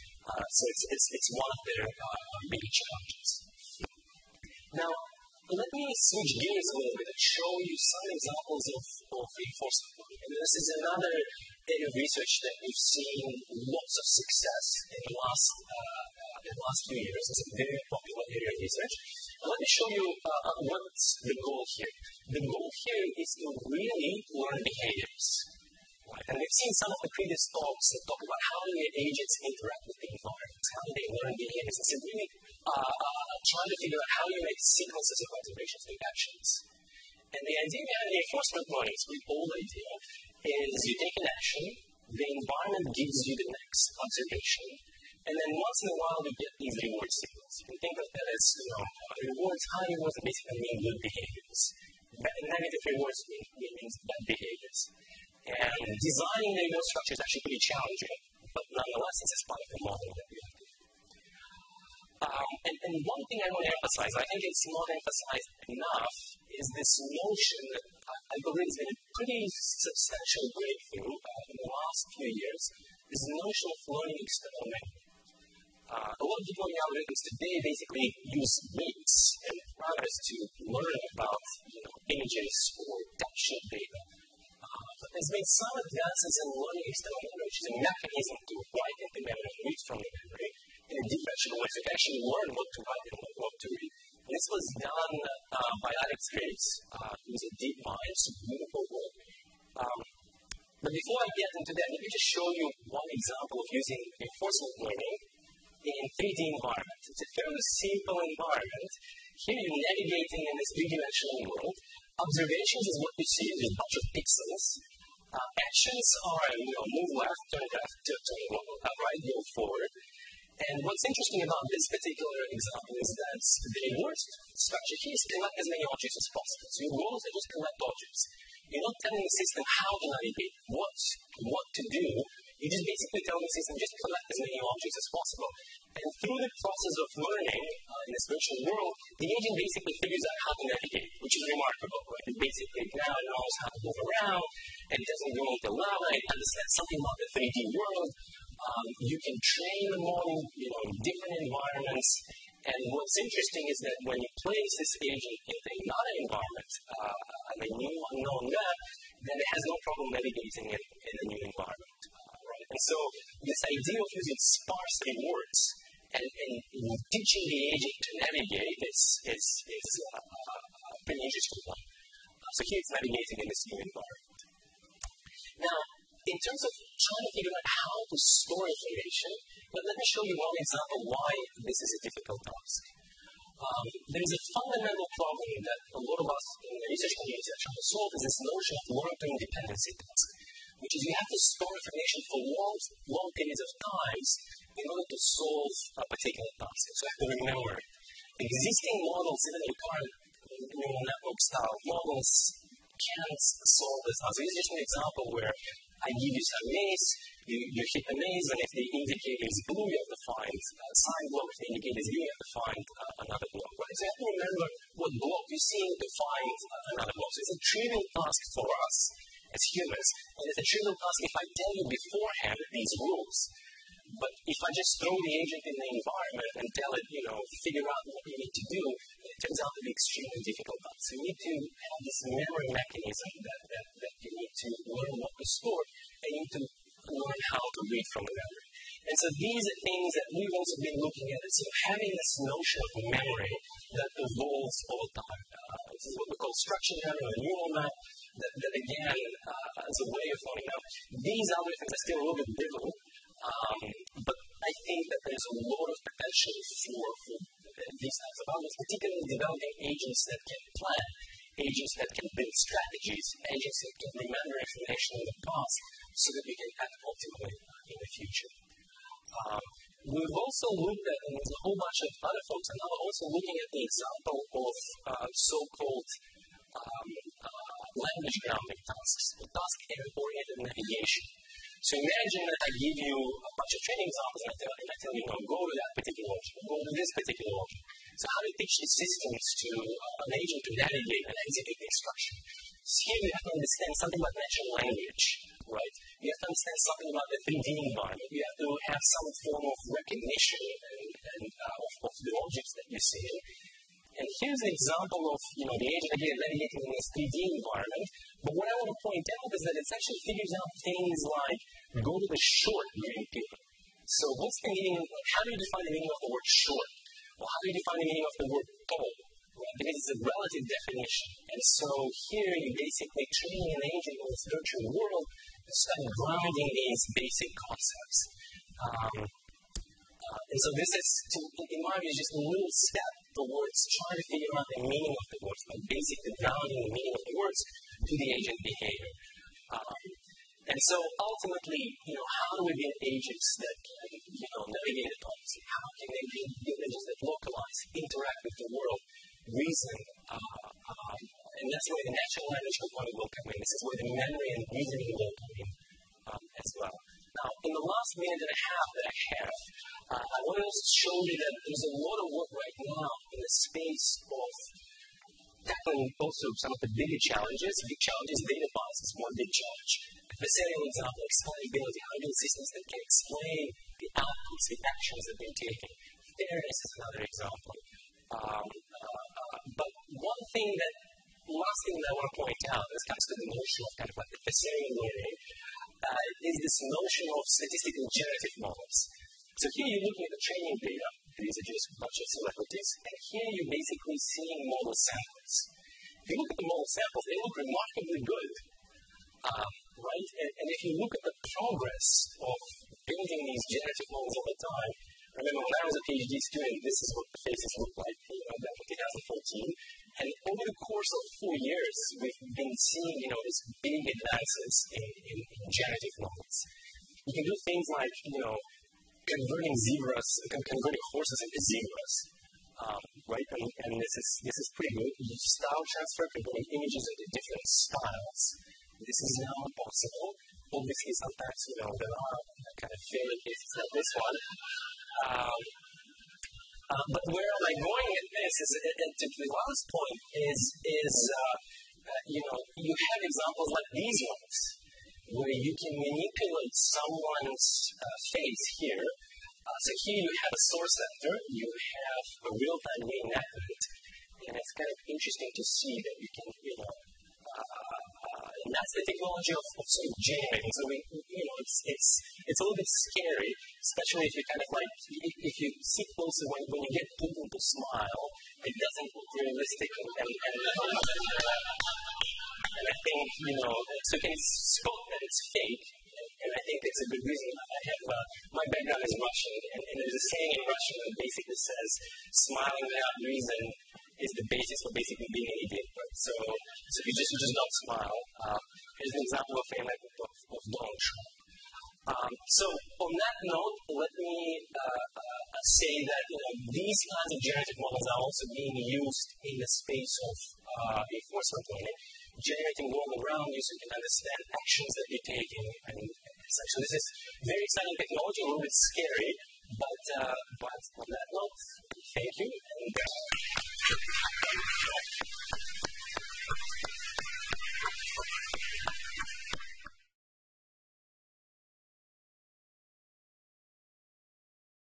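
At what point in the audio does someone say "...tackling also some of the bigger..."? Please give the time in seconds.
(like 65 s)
365 s.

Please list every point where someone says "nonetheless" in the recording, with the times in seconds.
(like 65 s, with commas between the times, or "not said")
58 s.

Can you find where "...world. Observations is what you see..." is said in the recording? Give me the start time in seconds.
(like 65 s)
111 s.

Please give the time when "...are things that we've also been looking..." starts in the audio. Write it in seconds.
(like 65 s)
239 s.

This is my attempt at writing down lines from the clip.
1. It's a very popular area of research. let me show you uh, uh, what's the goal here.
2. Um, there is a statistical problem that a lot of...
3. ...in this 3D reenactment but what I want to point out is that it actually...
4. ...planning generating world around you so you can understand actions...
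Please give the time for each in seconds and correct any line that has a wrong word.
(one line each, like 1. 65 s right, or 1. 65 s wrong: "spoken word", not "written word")
1. 17 s right
2. 183 s wrong: "fundamental", not "statistical"
3. 306 s wrong: "environment", not "reenactment"
4. 501 s right.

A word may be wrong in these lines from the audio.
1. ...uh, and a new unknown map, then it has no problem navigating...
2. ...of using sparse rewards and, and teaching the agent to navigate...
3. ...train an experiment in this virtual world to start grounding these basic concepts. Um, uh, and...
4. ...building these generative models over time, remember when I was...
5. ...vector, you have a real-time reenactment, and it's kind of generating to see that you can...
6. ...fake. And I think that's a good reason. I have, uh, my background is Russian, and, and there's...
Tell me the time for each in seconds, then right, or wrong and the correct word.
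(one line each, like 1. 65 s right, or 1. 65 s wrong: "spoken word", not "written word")
1. 156 s right
2. 163 s right
3. 323 s wrong: "agent", not "experiment"
4. 403 s right
5. 450 s wrong: "interesting", not "generating"
6. 475 s right.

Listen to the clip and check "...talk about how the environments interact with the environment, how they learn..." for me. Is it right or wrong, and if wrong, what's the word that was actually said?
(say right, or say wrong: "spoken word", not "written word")
wrong: "agents", not "environments".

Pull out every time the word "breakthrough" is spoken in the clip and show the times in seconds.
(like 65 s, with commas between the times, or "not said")
70 s.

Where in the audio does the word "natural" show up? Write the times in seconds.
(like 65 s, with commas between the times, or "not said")
294 s, 352 s.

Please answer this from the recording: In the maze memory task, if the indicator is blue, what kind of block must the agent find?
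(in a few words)
sign block.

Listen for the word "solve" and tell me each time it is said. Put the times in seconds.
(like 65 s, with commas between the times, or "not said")
187 s, 195 s, 203 s.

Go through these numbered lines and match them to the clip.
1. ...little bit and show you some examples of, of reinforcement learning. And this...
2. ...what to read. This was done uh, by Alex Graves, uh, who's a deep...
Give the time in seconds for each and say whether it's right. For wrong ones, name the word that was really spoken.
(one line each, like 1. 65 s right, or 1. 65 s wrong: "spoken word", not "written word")
1. 6 s right
2. 93 s right.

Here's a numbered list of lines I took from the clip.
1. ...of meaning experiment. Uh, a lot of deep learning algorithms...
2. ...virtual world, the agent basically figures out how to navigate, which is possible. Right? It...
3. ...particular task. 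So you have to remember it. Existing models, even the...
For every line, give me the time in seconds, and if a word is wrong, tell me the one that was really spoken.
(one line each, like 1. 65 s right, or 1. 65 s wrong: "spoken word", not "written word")
1. 73 s wrong: "learning", not "meaning"
2. 138 s wrong: "remarkable", not "possible"
3. 196 s right.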